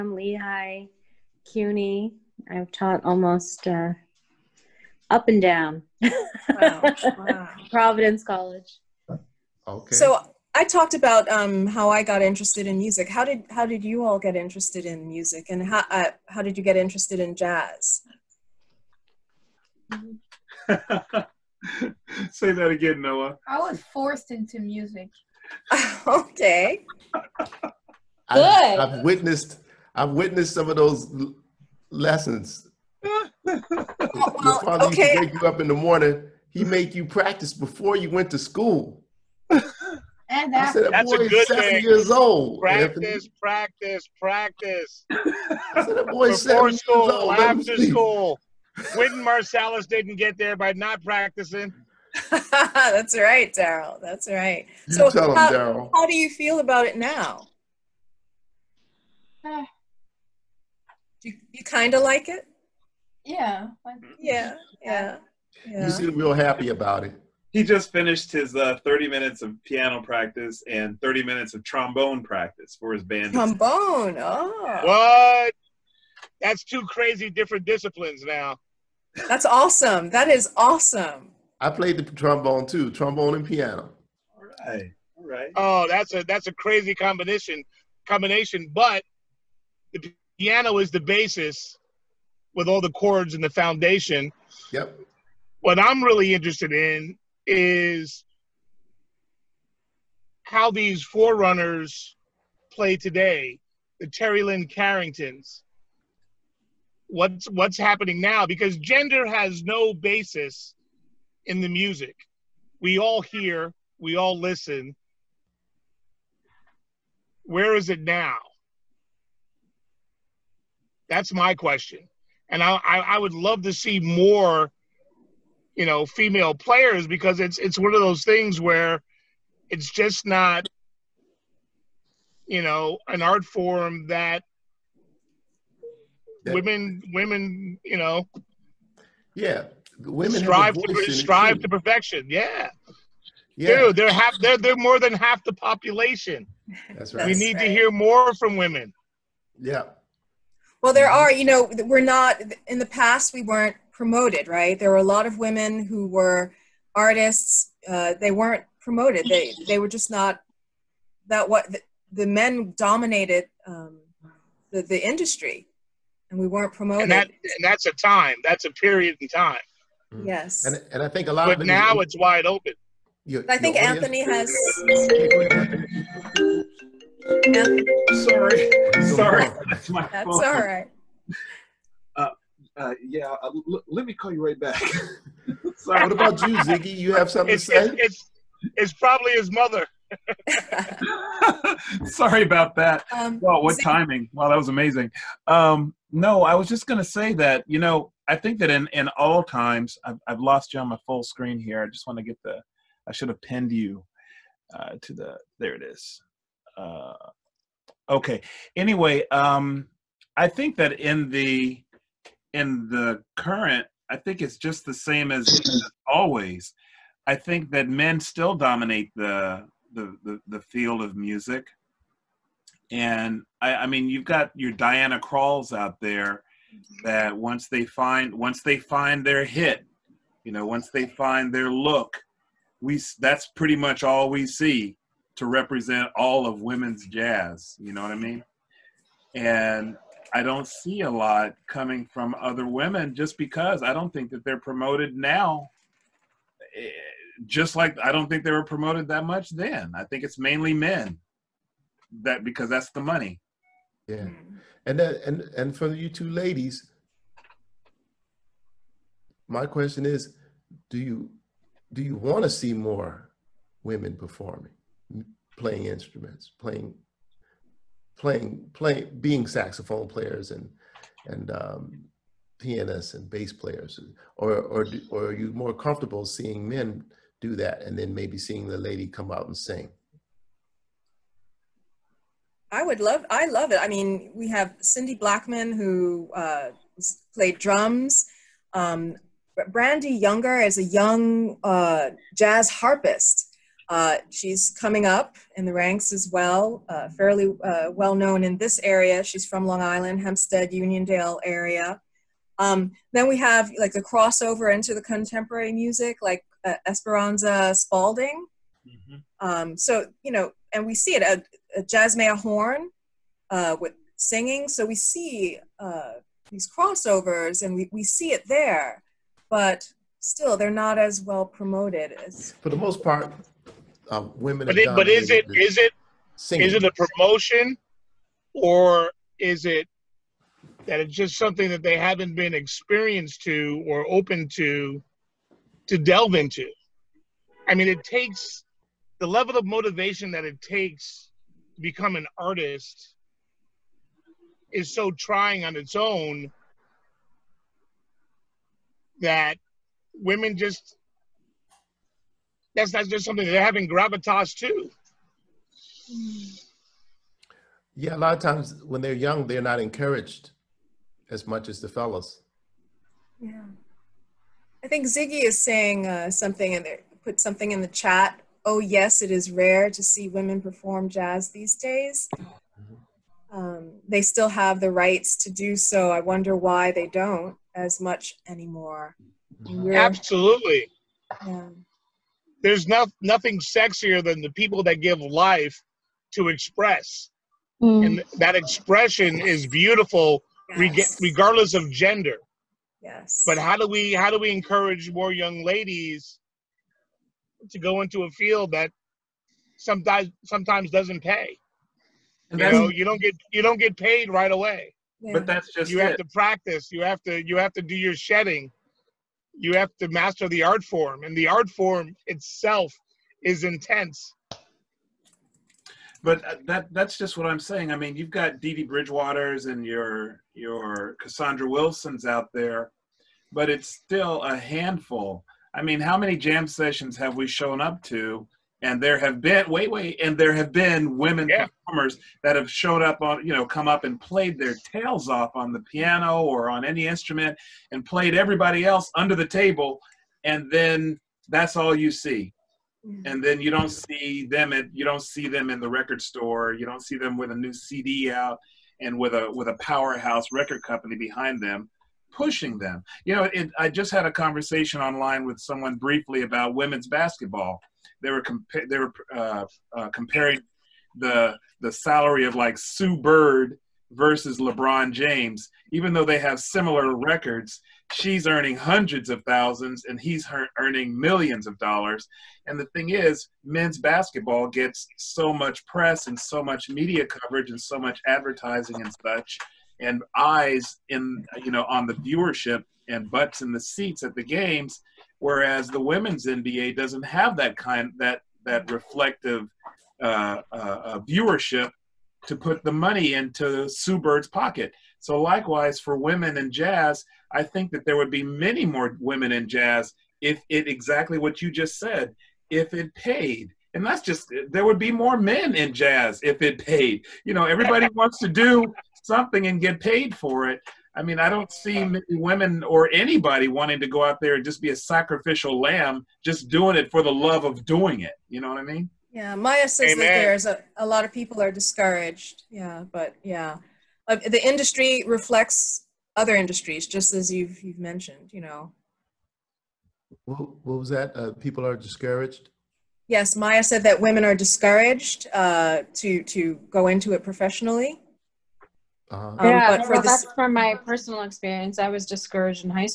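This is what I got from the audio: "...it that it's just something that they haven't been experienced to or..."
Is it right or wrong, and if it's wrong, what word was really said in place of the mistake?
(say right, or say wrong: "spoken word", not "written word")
right.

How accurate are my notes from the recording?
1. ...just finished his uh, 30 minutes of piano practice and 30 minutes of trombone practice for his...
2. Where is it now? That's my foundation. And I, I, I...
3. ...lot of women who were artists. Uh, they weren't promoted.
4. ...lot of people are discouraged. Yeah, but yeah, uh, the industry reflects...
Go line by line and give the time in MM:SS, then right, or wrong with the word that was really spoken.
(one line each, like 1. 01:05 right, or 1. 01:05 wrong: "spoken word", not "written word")
1. 01:07 right
2. 01:57 wrong: "question", not "foundation"
3. 02:35 right
4. 08:41 right.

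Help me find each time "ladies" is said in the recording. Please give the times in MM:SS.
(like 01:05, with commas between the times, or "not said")
04:16, 06:35.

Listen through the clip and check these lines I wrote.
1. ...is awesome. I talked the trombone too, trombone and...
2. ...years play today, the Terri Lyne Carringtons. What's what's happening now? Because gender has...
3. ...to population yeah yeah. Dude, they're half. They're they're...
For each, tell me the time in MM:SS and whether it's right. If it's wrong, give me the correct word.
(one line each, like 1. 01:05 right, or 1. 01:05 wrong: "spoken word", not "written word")
1. 01:20 wrong: "played", not "talked"
2. 01:41 wrong: "forerunners", not "years"
3. 02:21 wrong: "perfection", not "population".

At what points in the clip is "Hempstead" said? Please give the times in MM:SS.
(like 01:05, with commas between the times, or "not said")
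05:00.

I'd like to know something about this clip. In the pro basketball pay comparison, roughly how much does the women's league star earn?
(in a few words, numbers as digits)
Hundreds of thousands.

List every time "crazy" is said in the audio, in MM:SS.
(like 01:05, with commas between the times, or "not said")
01:16, 01:26.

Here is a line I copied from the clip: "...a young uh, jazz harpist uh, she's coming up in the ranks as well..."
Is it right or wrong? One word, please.
right.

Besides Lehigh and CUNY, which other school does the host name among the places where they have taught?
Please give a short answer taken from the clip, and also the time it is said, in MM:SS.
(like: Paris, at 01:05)
Providence College, at 00:07.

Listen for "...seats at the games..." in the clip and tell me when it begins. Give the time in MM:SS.
08:03.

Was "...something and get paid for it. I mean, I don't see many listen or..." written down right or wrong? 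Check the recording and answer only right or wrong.
wrong.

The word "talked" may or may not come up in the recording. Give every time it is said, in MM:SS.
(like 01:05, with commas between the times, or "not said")
00:10.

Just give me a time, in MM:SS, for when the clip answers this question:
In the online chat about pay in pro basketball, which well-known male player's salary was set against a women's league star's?
07:44.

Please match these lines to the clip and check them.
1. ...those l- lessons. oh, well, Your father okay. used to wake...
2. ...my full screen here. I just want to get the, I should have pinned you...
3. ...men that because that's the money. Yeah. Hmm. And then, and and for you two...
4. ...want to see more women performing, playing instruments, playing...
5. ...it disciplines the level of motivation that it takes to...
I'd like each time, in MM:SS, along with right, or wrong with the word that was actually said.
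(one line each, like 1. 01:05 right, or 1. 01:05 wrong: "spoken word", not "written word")
1. 00:30 right
2. 03:20 right
3. 04:10 right
4. 04:22 right
5. 05:37 wrong: "takes", not "disciplines".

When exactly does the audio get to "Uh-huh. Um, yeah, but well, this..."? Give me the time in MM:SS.
08:59.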